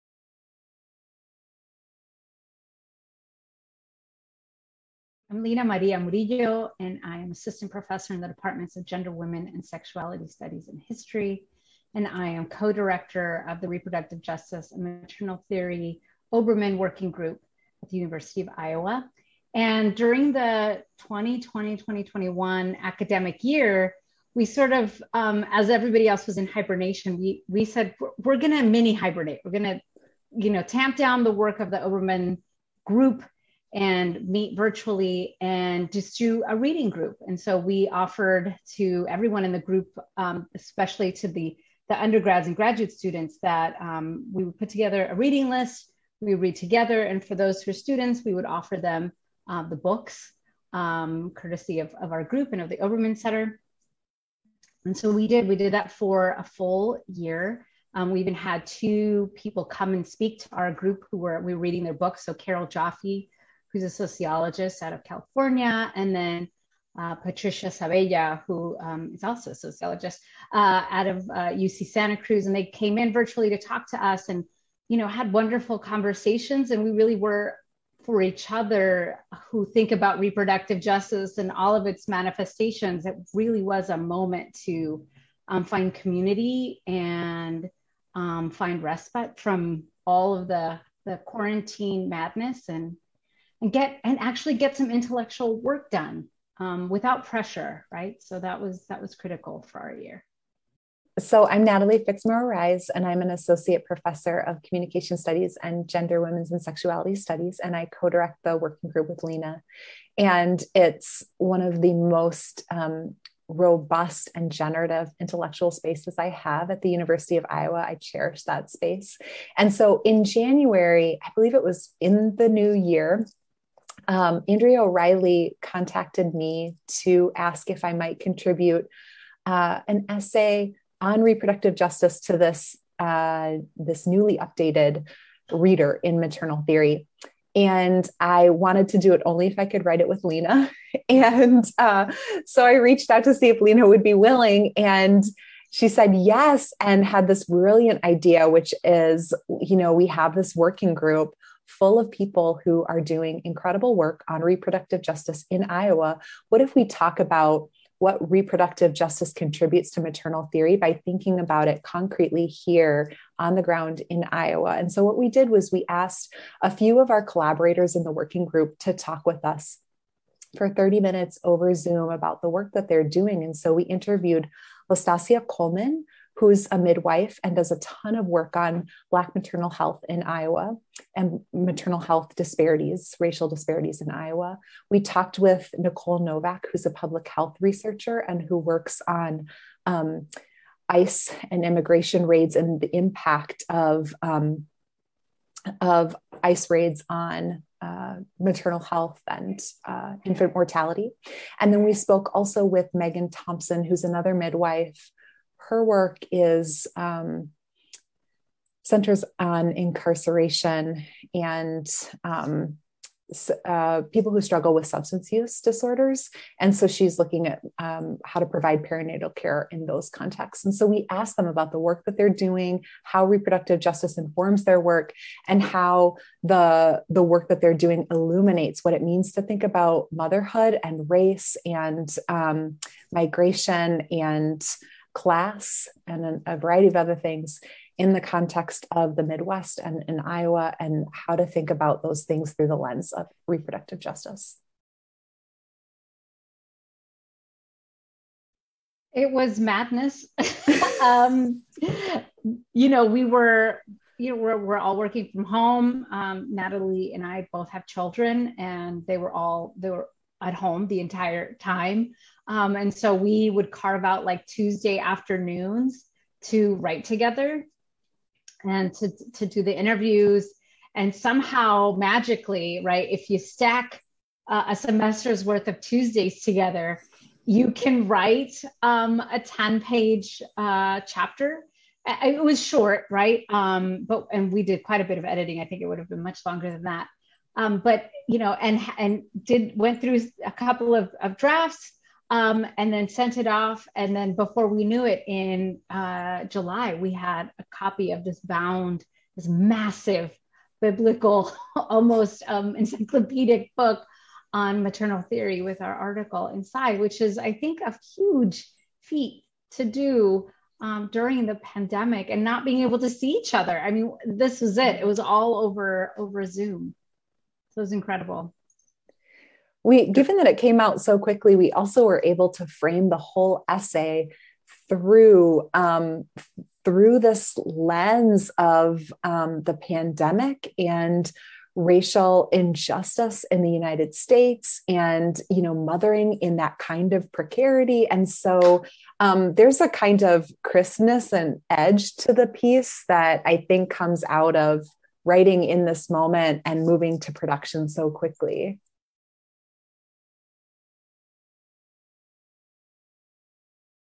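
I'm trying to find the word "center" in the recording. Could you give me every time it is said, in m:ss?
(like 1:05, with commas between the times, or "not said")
0:53, 3:28.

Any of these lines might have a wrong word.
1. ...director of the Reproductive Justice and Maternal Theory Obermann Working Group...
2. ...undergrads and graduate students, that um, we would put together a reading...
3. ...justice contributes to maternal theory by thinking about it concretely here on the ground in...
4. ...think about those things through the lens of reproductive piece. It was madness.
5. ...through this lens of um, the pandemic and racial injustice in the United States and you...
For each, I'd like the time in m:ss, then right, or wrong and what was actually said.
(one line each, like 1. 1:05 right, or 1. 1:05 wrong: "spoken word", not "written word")
1. 0:12 right
2. 0:42 right
3. 2:38 right
4. 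4:01 wrong: "justice", not "piece"
5. 5:26 right.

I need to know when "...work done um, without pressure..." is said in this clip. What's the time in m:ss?
1:35.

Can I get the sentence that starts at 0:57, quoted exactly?
Um, we even had two people come and speak to our group who were, we were reading their books.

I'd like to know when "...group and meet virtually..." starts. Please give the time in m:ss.
0:32.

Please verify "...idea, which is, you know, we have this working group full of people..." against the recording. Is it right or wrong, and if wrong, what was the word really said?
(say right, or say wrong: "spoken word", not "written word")
right.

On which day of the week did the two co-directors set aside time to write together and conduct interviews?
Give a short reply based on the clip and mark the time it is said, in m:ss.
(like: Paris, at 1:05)
Tuesday, at 4:24.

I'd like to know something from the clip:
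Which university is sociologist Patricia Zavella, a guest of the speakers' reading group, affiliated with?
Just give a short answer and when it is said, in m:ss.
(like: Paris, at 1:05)
UC Santa Cruz, at 1:11.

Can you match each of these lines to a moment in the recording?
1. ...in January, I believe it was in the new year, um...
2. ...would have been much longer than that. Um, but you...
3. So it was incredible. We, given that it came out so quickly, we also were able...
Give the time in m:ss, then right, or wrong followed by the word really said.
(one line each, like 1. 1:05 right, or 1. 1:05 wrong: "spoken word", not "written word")
1. 2:00 right
2. 4:45 right
3. 5:17 right.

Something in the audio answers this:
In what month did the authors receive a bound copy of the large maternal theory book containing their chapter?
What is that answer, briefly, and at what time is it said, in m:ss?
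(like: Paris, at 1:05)
July, at 4:56.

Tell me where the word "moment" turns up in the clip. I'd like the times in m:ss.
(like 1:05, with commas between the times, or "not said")
1:23, 5:46.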